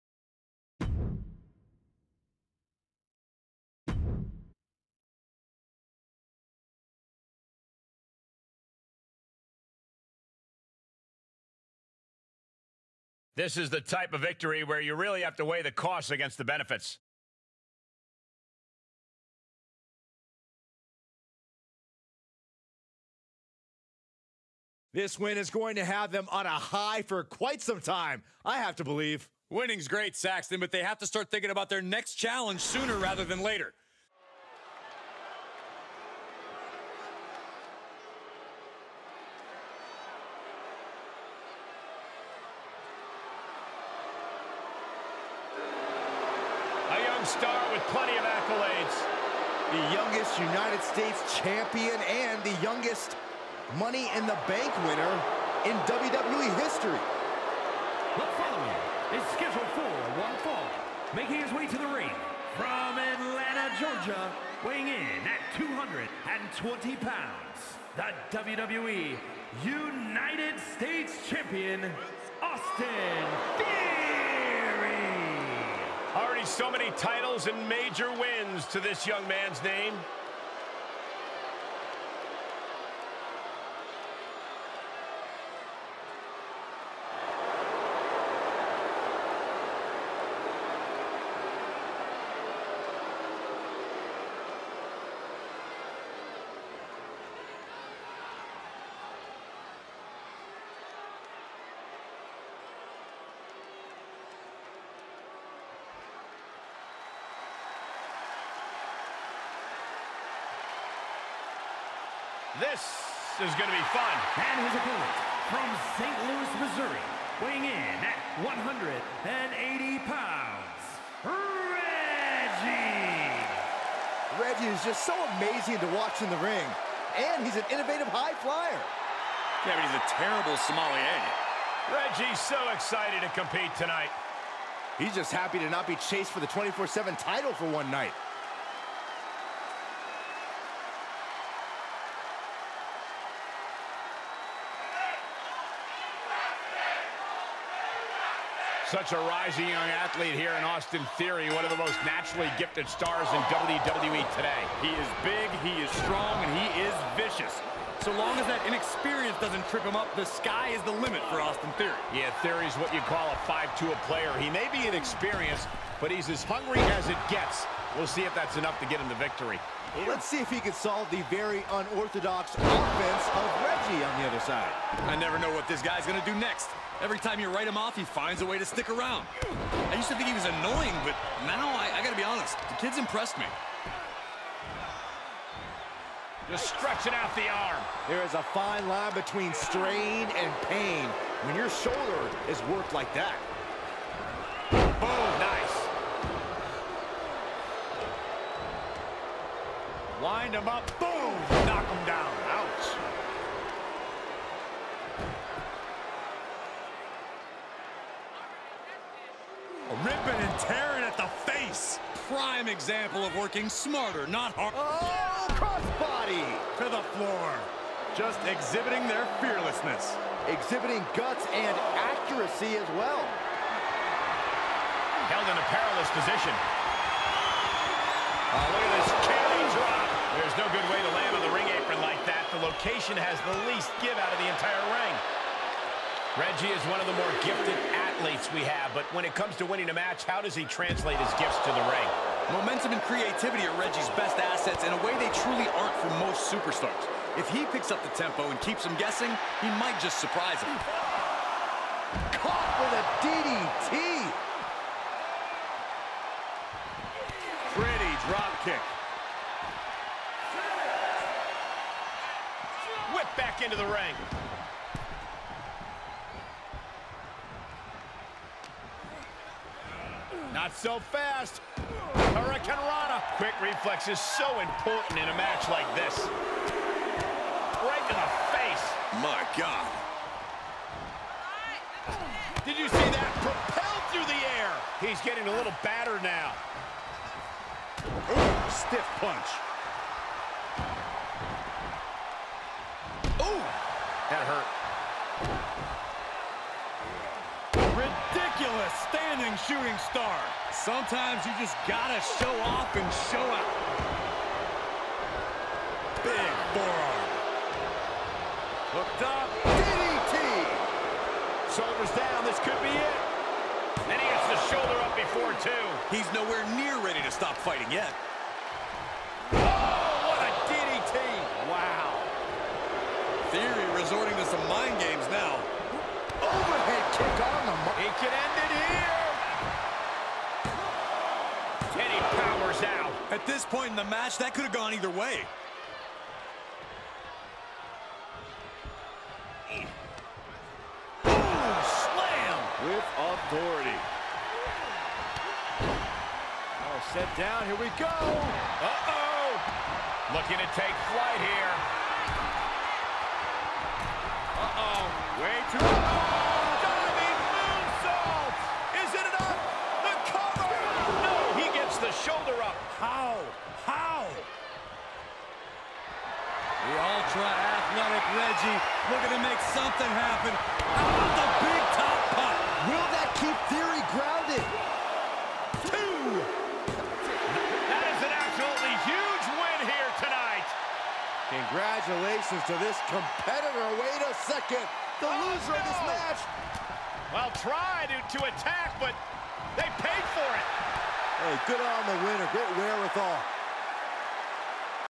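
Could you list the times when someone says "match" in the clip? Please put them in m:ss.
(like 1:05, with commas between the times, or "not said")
3:59, 4:35, 5:34, 6:26.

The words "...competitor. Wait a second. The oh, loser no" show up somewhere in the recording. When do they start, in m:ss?
6:23.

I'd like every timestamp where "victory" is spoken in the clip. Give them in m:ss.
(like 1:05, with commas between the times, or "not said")
0:14, 2:49.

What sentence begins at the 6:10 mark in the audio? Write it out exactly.
How oh, about the big top punt?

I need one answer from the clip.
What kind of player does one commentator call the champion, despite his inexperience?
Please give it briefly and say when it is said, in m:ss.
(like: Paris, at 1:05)
5-2 player, at 2:43.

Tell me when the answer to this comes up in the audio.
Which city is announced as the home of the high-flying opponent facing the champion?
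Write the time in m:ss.
1:55.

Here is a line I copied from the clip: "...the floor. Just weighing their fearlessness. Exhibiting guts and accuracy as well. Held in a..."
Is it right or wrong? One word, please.
wrong.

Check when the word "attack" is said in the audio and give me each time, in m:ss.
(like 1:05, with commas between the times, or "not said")
6:28.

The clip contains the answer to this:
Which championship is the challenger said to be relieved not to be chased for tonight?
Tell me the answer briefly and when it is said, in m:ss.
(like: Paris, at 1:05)
24-7 title, at 2:16.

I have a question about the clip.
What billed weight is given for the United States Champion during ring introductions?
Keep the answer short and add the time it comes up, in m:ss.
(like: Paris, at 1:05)
220 pounds, at 1:05.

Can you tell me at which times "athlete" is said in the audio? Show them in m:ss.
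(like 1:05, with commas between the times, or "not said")
2:30, 3:57.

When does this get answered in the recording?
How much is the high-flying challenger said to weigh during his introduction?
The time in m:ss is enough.
1:58.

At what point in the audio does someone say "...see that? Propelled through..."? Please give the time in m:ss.
4:42.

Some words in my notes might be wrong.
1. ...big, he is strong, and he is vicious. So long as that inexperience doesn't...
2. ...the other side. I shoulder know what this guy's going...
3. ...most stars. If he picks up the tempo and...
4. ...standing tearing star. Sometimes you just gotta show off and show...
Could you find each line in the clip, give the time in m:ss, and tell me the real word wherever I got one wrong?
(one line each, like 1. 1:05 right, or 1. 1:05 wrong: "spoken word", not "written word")
1. 2:35 right
2. 2:54 wrong: "never", not "shoulder"
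3. 4:06 wrong: "superstars", not "stars"
4. 4:59 wrong: "shooting", not "tearing".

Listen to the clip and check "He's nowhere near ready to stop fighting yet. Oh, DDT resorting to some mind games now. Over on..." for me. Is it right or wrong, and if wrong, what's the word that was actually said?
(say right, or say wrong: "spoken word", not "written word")
wrong: "Theory", not "DDT".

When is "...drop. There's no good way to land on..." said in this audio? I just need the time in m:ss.
3:49.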